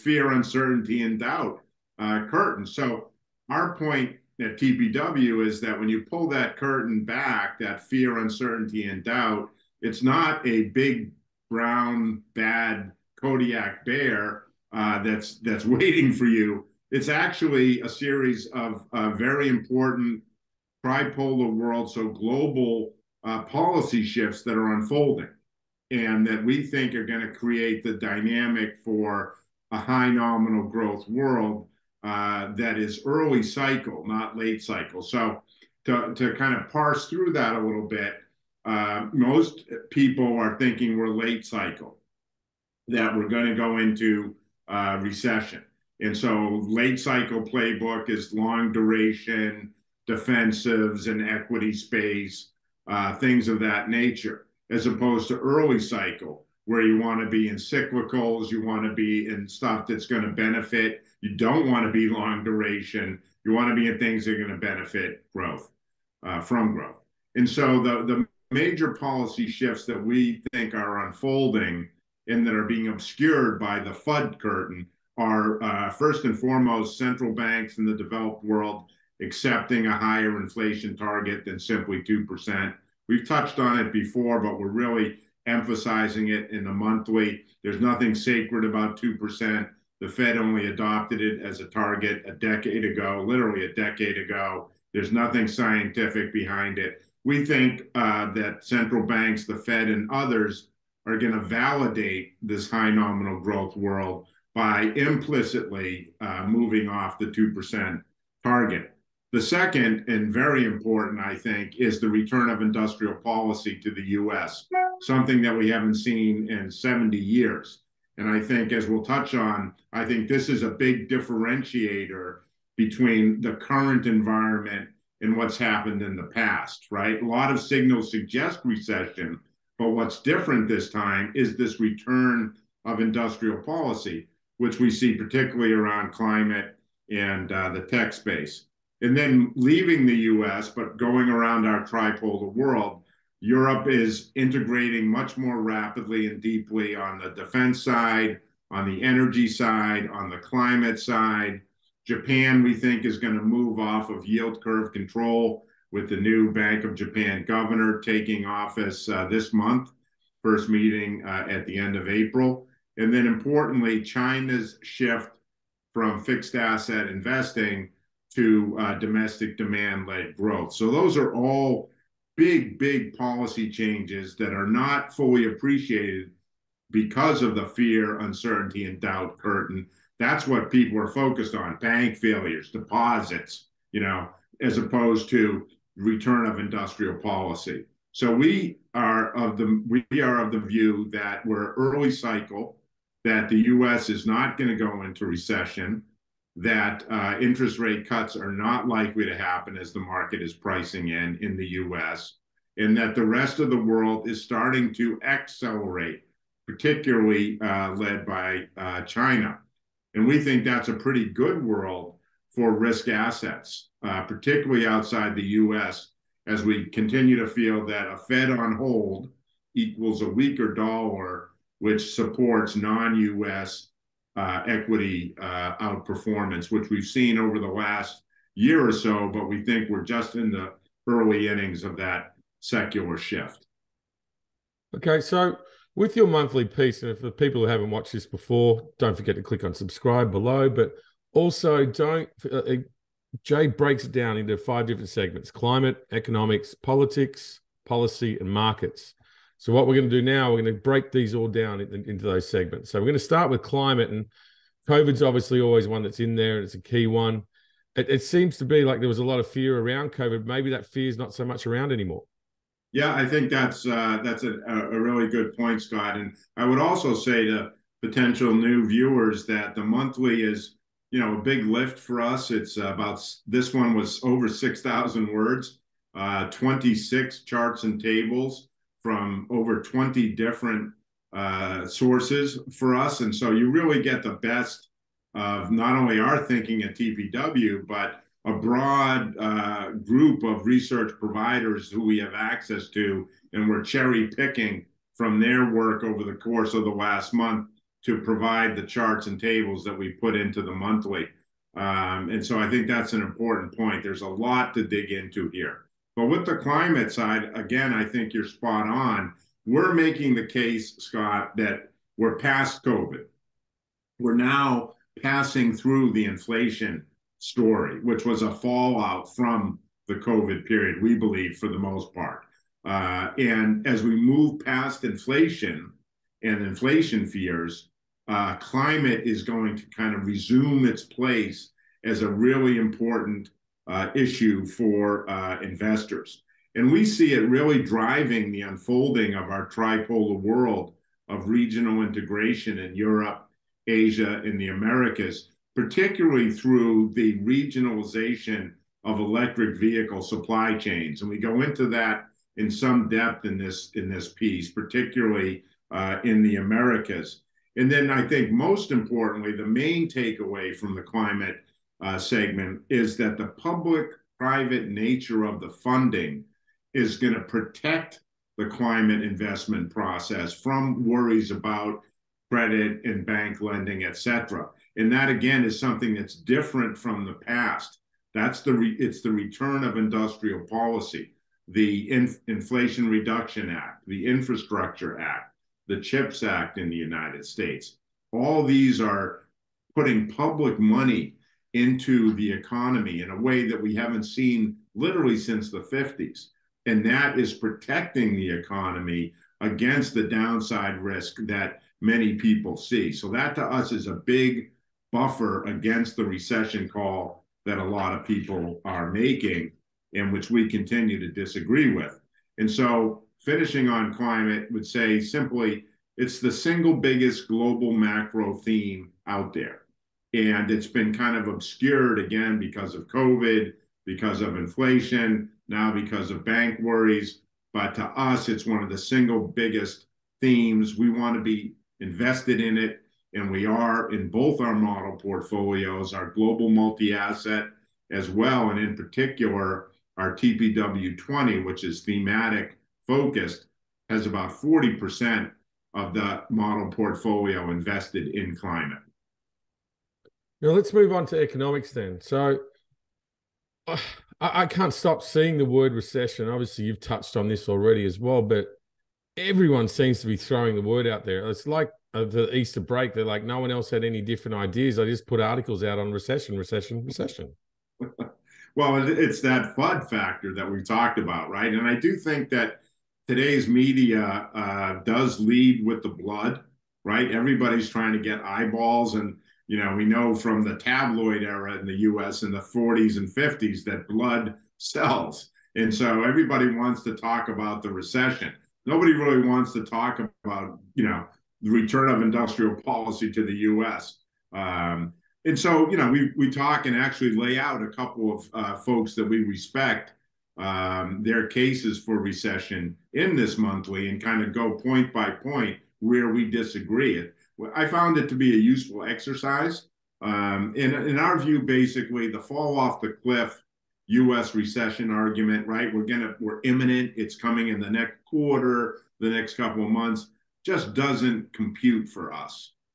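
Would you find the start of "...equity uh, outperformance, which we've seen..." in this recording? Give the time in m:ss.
3:44.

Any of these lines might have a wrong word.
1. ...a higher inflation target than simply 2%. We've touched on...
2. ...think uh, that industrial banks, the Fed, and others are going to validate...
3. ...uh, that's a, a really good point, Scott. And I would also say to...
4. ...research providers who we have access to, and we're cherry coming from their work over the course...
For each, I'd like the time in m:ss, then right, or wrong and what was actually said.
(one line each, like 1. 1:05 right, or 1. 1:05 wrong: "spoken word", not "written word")
1. 1:19 right
2. 1:37 wrong: "central", not "industrial"
3. 4:23 right
4. 4:50 wrong: "picking", not "coming".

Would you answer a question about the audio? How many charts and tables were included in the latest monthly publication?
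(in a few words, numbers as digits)
26.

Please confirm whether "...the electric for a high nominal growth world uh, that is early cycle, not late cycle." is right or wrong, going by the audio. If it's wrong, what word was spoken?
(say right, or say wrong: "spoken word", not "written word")
wrong: "dynamic", not "electric".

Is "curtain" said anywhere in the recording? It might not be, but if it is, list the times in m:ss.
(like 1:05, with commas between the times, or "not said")
0:02, 0:06, 1:14, 2:59.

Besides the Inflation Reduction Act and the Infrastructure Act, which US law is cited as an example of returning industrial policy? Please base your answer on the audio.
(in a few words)
CHIPS Act.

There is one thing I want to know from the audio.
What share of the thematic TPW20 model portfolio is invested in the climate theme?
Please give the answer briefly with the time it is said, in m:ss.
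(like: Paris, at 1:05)
40%, at 7:24.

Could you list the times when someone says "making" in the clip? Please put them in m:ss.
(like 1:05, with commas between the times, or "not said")
5:09, 6:49.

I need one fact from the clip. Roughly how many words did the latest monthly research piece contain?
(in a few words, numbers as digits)
over 6,000.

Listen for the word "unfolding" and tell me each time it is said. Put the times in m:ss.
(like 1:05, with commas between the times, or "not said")
0:24, 1:11, 5:38.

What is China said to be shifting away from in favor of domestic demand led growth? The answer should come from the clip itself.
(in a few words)
fixed asset investing.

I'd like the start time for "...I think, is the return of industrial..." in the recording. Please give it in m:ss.
1:51.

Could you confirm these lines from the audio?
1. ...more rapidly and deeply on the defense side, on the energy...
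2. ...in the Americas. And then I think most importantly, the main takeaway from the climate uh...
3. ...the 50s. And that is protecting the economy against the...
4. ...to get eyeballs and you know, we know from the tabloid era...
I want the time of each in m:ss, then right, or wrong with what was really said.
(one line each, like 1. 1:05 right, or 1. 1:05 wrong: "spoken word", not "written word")
1. 2:25 right
2. 5:56 right
3. 6:35 right
4. 7:58 right.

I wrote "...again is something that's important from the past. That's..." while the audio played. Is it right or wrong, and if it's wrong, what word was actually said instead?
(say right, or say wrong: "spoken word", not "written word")
wrong: "different", not "important".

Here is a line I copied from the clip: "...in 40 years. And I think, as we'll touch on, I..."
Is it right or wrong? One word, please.
wrong.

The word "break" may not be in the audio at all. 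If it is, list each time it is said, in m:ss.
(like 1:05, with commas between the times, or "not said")
4:03, 4:10, 7:42.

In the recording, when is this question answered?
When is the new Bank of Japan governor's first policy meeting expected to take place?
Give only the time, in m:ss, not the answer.
2:41.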